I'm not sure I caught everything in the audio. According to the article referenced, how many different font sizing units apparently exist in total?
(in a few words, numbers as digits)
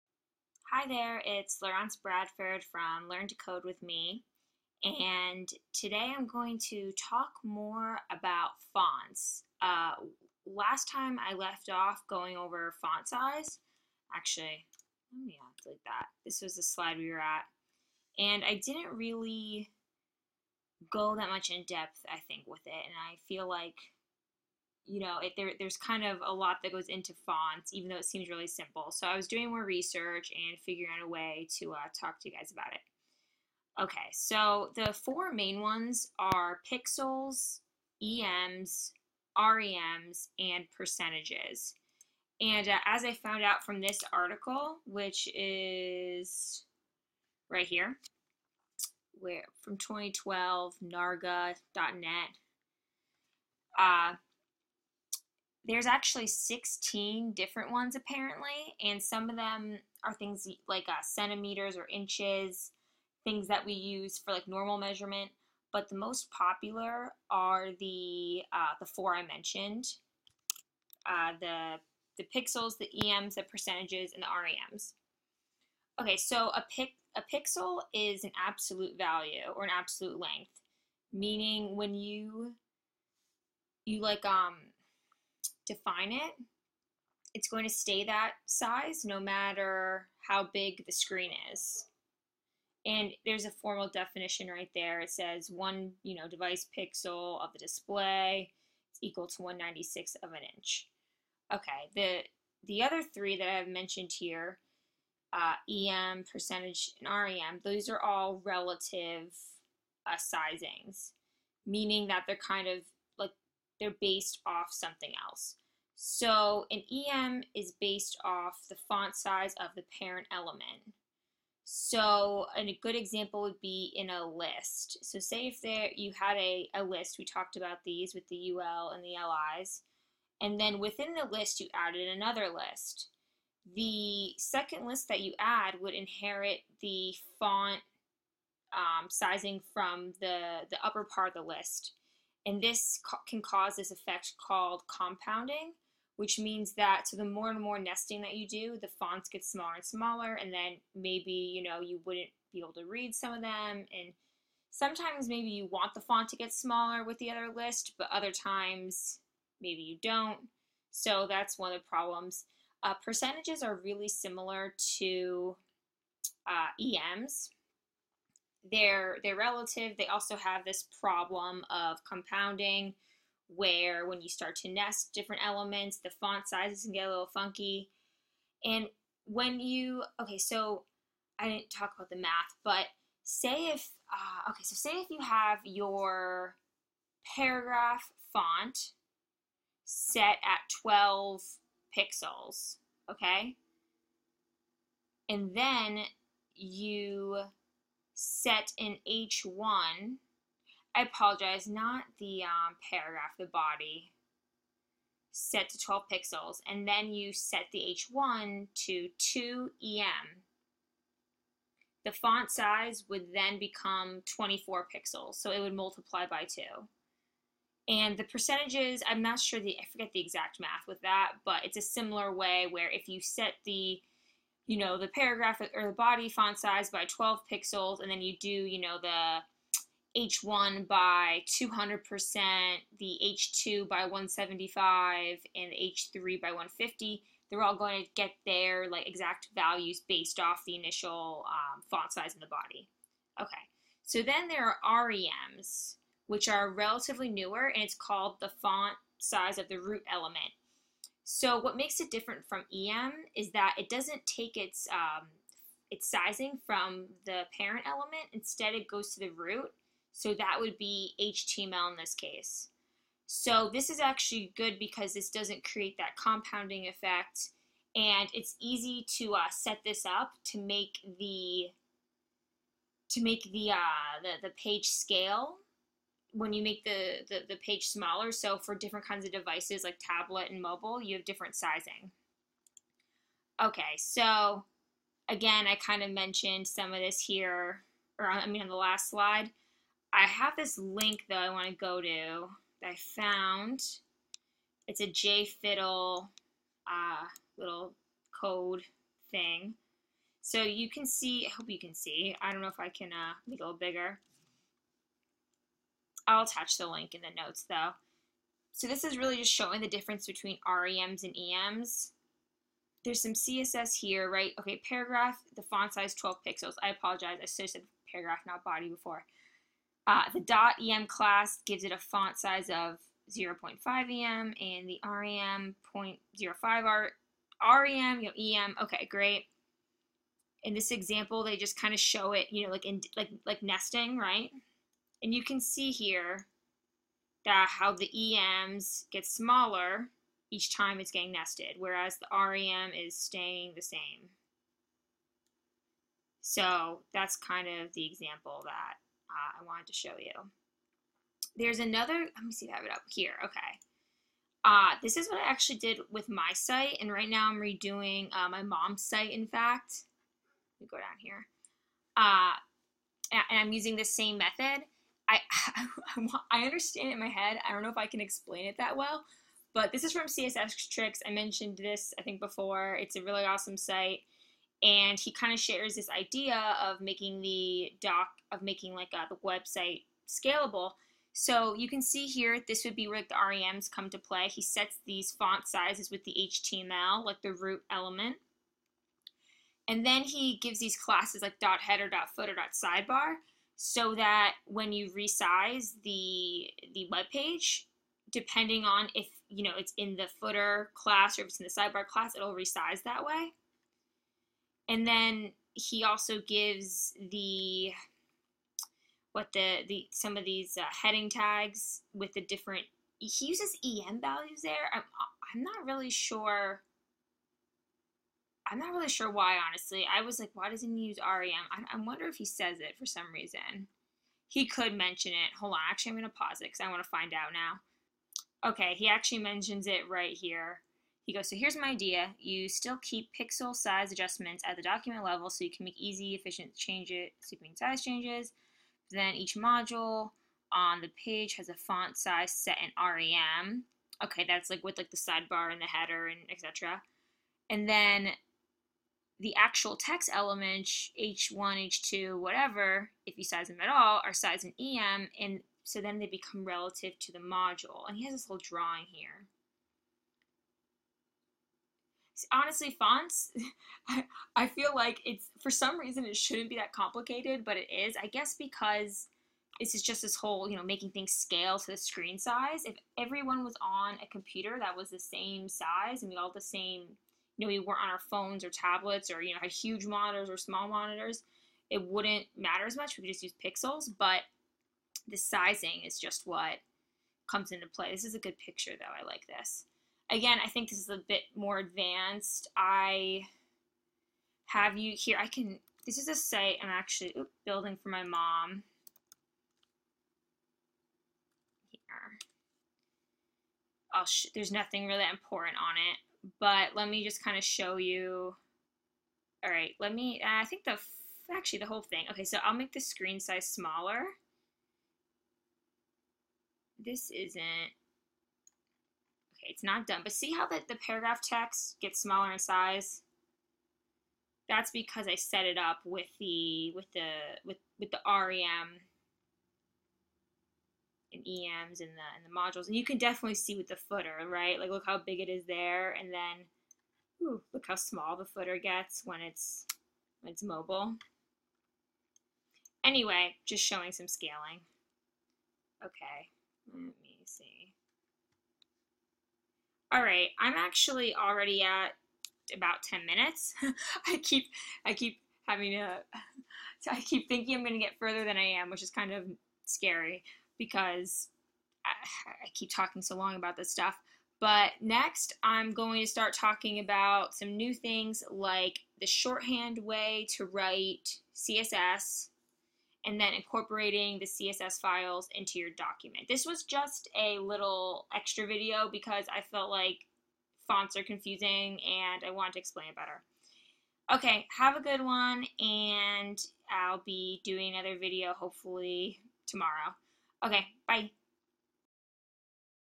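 16.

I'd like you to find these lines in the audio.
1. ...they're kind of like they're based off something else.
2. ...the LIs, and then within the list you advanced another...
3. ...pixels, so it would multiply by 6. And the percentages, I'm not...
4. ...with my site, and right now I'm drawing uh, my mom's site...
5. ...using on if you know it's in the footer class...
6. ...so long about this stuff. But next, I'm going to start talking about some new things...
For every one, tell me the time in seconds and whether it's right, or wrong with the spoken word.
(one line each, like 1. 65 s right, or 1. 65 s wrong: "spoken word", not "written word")
1. 112 s right
2. 129 s wrong: "added", not "advanced"
3. 214 s wrong: "2", not "6"
4. 356 s wrong: "redoing", not "drawing"
5. 398 s wrong: "depending", not "using"
6. 563 s right.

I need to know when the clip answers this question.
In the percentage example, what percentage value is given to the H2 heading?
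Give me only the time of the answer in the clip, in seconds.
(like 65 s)
234 s.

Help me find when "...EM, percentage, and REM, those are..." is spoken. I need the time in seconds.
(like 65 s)
105 s.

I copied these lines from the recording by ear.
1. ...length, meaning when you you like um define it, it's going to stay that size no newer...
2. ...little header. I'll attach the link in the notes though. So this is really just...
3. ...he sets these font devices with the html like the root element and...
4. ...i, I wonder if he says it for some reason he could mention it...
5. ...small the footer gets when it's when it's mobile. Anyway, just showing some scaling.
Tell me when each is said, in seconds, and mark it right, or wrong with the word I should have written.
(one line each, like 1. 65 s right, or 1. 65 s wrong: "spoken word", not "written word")
1. 80 s wrong: "matter", not "newer"
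2. 303 s wrong: "bigger", not "header"
3. 384 s wrong: "sizes", not "devices"
4. 421 s right
5. 537 s right.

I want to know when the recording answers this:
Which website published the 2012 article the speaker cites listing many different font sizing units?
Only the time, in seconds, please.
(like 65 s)
50 s.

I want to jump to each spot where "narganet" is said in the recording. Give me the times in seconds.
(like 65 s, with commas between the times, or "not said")
50 s.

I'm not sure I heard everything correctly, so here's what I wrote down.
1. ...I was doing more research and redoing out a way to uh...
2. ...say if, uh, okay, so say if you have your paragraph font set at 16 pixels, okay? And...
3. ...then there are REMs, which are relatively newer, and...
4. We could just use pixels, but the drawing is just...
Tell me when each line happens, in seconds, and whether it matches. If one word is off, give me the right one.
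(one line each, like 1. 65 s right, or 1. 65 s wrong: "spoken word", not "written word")
1. 29 s wrong: "figuring", not "redoing"
2. 183 s wrong: "12", not "16"
3. 244 s right
4. 483 s wrong: "sizing", not "drawing".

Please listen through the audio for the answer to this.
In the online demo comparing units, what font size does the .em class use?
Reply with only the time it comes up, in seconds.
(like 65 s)
323 s.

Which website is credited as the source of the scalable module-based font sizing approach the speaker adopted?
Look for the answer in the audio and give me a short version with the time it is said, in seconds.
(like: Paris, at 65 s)
CSS Tricks, at 370 s.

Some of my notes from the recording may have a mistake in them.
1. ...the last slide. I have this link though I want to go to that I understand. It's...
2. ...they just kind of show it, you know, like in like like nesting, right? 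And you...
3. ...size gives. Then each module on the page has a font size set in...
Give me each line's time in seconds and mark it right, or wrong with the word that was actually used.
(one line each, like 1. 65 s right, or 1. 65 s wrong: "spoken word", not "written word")
1. 288 s wrong: "found", not "understand"
2. 331 s right
3. 437 s wrong: "changes", not "gives".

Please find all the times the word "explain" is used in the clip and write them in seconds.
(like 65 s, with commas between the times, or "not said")
368 s, 582 s.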